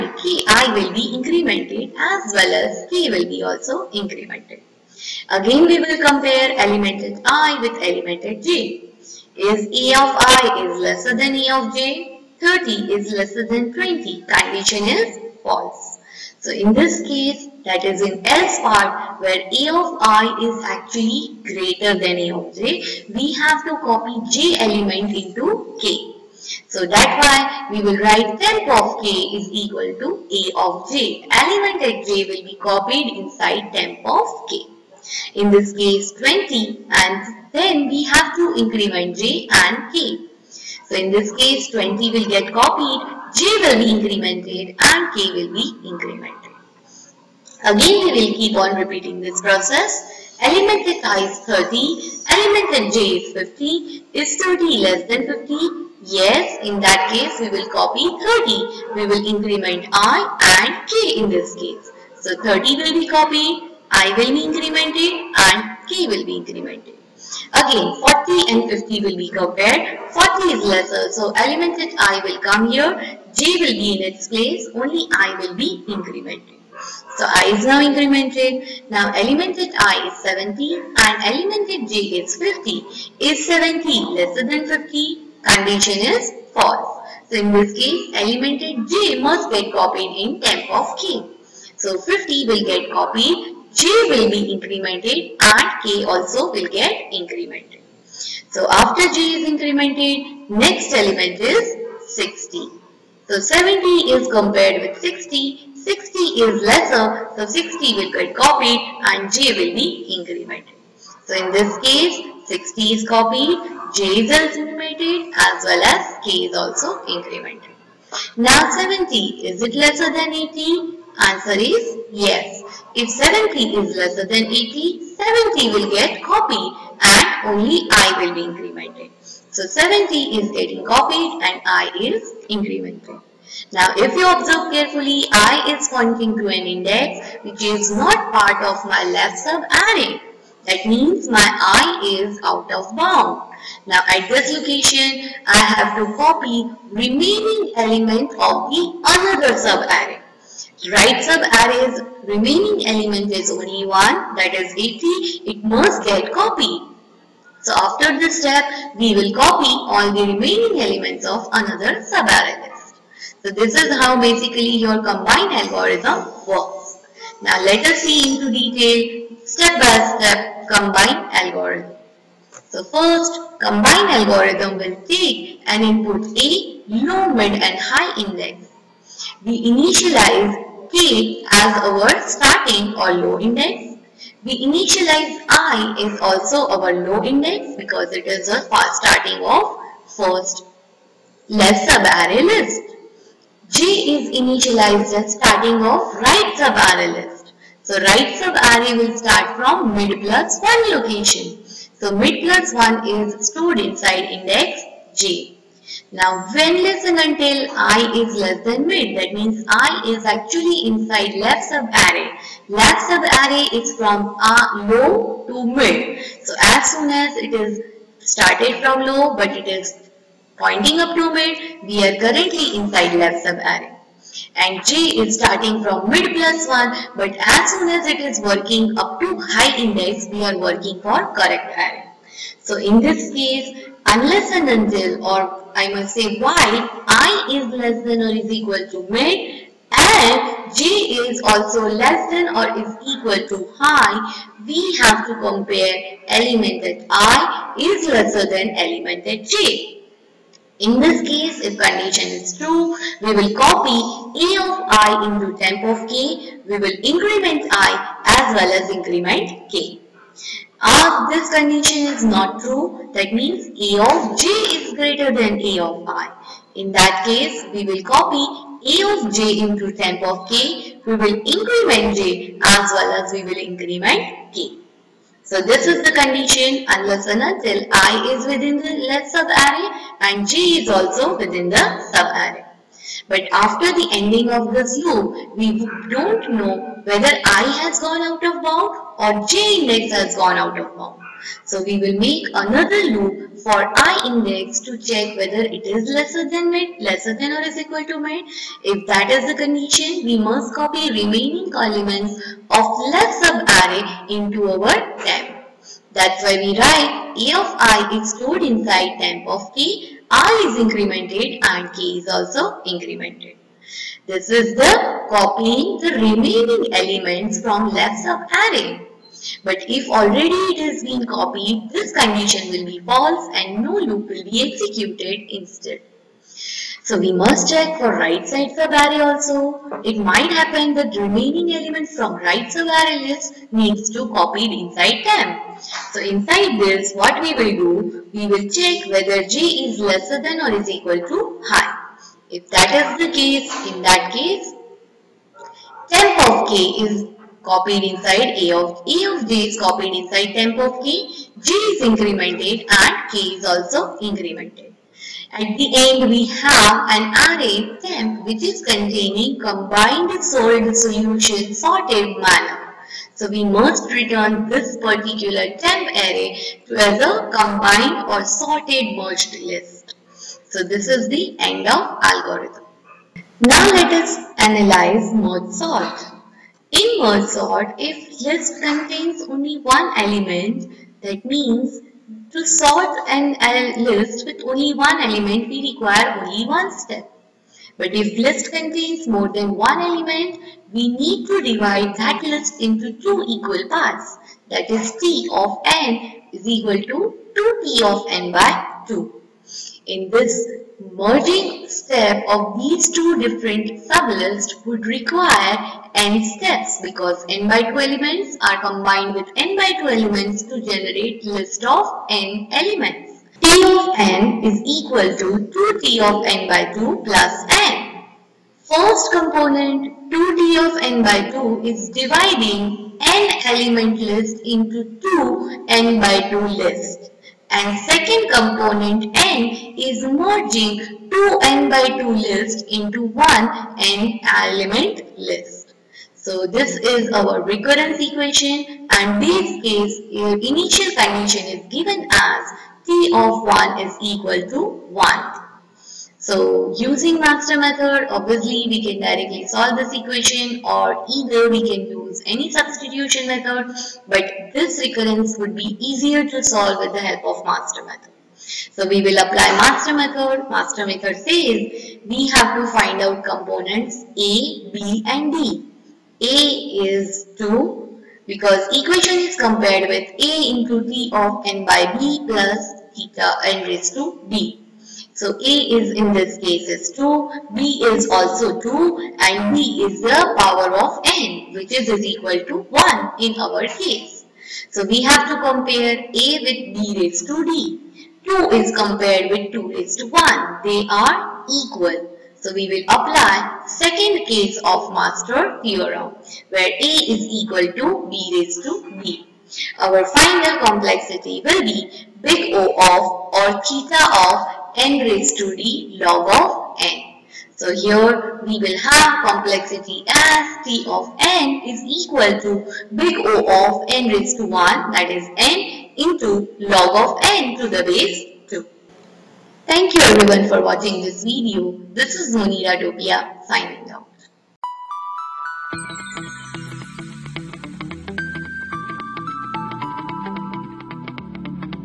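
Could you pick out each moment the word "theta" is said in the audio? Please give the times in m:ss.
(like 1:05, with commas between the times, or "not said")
7:53, 8:23.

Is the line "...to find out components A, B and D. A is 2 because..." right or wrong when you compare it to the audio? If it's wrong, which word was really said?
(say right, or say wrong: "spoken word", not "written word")
right.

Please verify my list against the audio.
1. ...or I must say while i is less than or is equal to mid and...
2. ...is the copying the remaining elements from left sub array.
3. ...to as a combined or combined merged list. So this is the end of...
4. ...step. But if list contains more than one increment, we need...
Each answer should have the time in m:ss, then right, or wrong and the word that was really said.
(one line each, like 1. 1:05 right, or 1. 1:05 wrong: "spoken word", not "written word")
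1. 3:55 right
2. 5:14 right
3. 6:06 wrong: "sorted", not "combined"
4. 6:26 wrong: "element", not "increment".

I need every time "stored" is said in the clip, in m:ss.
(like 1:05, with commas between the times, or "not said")
3:23, 5:08.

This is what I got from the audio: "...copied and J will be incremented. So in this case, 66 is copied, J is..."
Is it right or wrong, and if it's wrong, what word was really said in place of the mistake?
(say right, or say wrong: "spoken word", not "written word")
wrong: "60", not "66".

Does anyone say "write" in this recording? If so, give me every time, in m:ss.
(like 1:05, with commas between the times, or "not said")
0:27, 5:06.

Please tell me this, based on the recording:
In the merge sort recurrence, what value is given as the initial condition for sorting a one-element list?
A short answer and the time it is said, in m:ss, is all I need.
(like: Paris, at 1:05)
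T(1) = 1, at 7:23.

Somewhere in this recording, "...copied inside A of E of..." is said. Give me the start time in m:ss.
5:47.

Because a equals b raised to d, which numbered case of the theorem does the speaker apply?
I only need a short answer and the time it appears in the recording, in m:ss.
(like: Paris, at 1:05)
second case, at 8:13.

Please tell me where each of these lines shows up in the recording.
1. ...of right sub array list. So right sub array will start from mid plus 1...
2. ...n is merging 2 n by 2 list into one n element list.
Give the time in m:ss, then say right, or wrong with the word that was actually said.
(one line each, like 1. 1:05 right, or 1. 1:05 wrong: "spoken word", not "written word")
1. 3:15 right
2. 7:09 right.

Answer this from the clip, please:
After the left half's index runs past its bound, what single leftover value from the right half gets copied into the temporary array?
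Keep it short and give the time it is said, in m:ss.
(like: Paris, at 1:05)
80, at 2:34.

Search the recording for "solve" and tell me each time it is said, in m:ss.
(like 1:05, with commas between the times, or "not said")
7:29, 7:36.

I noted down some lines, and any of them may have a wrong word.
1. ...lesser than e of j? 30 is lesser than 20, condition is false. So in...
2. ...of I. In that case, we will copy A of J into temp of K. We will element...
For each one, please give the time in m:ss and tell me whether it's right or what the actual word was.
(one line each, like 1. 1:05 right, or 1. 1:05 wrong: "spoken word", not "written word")
1. 0:10 right
2. 4:25 wrong: "increment", not "element".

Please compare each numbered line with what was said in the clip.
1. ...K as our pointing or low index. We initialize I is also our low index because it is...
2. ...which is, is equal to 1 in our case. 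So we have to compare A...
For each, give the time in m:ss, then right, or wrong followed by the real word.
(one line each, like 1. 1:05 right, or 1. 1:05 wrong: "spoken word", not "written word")
1. 3:00 wrong: "starting", not "pointing"
2. 8:01 right.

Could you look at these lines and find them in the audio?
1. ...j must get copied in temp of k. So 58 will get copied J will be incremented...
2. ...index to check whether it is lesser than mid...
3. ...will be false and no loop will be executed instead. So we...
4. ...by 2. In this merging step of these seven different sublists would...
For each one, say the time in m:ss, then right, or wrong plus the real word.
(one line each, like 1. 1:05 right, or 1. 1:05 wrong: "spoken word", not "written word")
1. 1:28 wrong: "50", not "58"
2. 4:54 right
3. 5:22 right
4. 6:38 wrong: "two", not "seven".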